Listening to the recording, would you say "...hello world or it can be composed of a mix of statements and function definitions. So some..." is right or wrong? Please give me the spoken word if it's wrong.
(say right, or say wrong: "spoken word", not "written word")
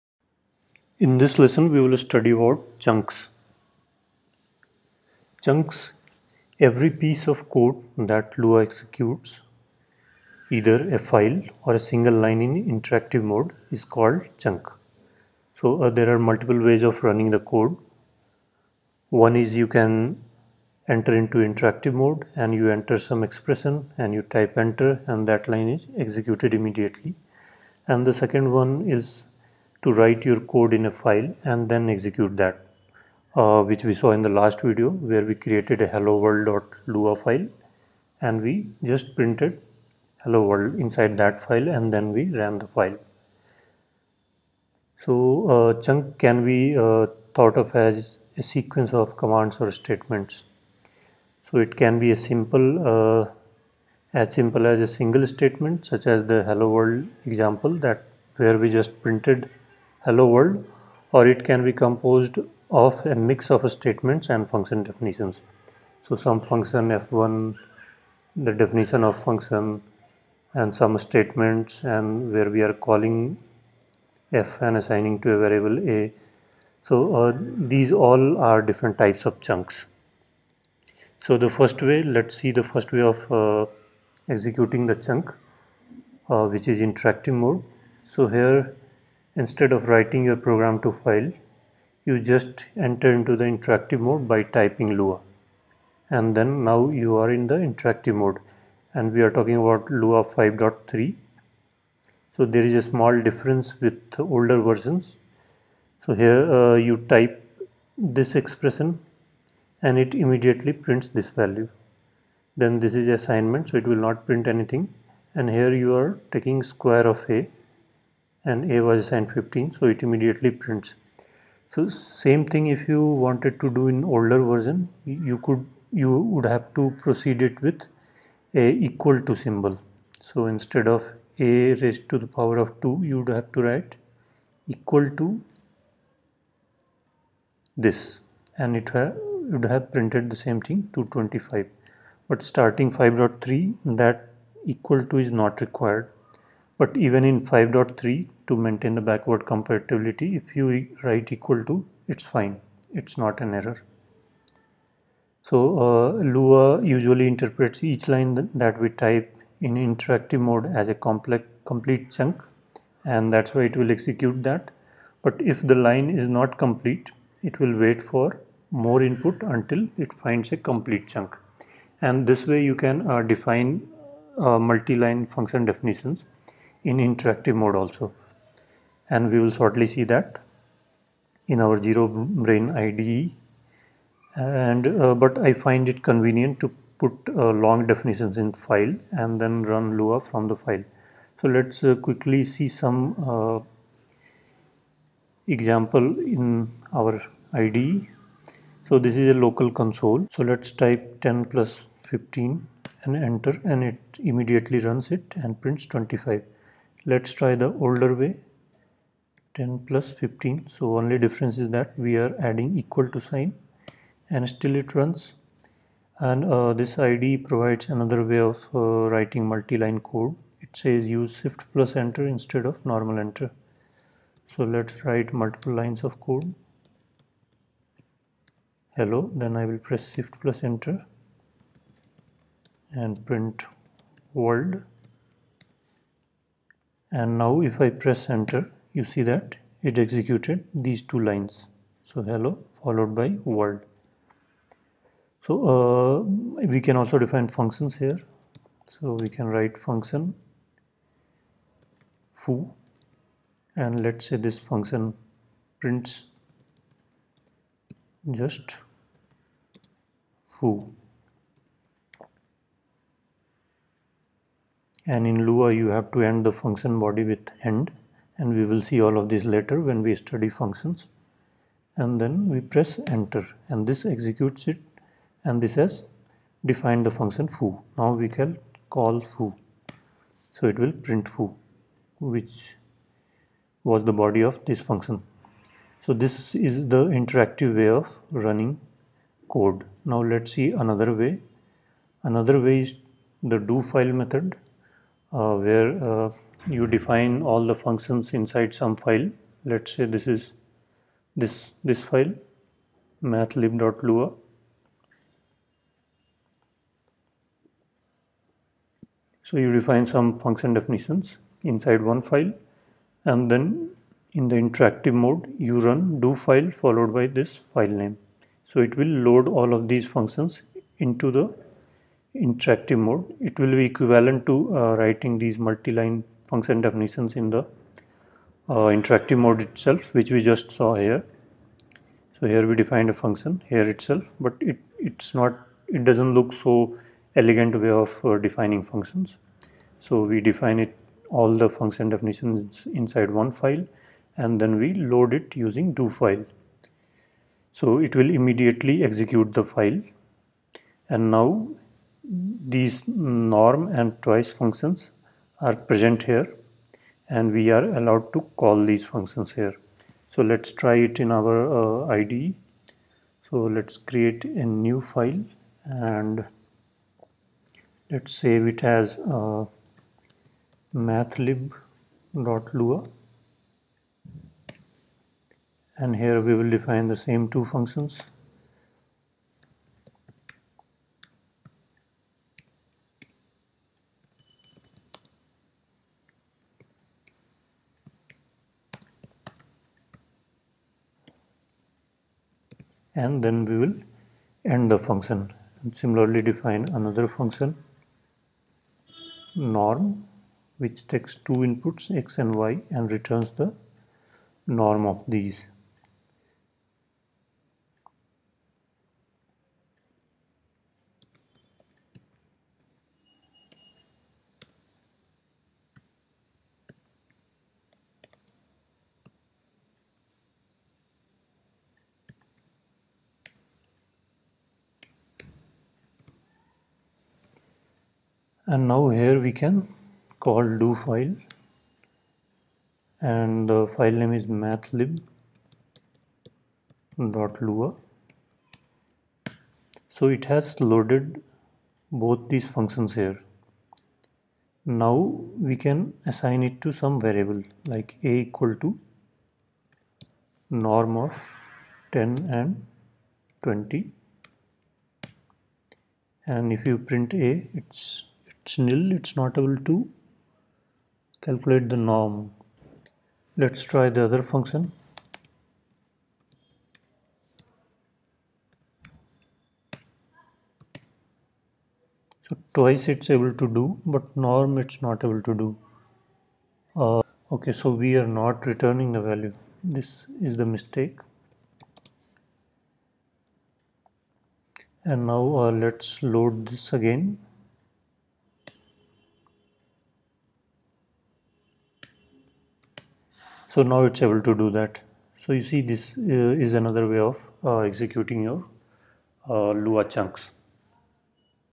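right.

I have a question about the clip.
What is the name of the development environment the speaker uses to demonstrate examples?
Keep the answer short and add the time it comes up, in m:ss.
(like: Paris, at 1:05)
ZeroBrane, at 3:01.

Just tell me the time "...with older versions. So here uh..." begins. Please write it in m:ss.
1:43.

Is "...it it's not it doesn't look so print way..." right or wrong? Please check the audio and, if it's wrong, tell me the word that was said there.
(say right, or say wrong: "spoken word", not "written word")
wrong: "elegant", not "print".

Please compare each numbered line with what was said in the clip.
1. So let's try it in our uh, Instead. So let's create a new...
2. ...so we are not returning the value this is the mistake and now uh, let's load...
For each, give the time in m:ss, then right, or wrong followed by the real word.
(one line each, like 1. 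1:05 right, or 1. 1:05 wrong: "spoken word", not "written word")
1. 6:00 wrong: "IDE", not "Instead"
2. 7:57 right.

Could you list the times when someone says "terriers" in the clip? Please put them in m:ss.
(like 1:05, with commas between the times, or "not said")
not said.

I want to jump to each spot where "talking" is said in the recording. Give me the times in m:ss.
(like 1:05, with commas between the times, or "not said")
1:39.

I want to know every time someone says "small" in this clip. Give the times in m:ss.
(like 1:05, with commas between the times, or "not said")
1:42.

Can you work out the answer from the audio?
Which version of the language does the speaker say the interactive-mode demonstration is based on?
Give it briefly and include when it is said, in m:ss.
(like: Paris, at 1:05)
Lua 5.3, at 1:39.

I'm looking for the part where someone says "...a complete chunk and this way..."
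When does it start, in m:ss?
2:50.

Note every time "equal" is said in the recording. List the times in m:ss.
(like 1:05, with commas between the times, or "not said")
2:08, 2:14, 2:24, 2:31, 3:32, 7:28.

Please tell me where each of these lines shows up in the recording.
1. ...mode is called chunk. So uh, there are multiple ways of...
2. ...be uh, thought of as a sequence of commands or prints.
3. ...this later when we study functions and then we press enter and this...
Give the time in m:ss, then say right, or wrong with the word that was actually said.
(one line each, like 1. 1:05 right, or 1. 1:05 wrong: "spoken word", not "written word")
1. 0:13 right
2. 0:46 wrong: "statements", not "prints"
3. 4:29 right.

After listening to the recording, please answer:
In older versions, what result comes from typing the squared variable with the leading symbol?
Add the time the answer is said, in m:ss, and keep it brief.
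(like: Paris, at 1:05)
225, at 2:20.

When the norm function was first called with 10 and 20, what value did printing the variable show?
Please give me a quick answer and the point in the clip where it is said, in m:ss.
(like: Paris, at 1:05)
nil, at 7:38.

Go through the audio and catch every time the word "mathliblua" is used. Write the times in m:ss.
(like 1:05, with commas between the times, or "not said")
5:03, 6:10.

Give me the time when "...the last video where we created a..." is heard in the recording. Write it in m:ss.
0:34.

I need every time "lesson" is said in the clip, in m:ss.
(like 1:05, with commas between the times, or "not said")
0:01.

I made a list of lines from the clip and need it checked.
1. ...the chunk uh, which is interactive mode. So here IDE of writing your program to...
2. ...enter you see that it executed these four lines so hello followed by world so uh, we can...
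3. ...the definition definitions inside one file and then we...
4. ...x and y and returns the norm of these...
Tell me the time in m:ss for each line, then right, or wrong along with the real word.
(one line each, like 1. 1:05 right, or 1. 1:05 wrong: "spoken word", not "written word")
1. 1:24 wrong: "Instead", not "IDE"
2. 3:58 wrong: "two", not "four"
3. 5:41 wrong: "function", not "definition"
4. 6:42 right.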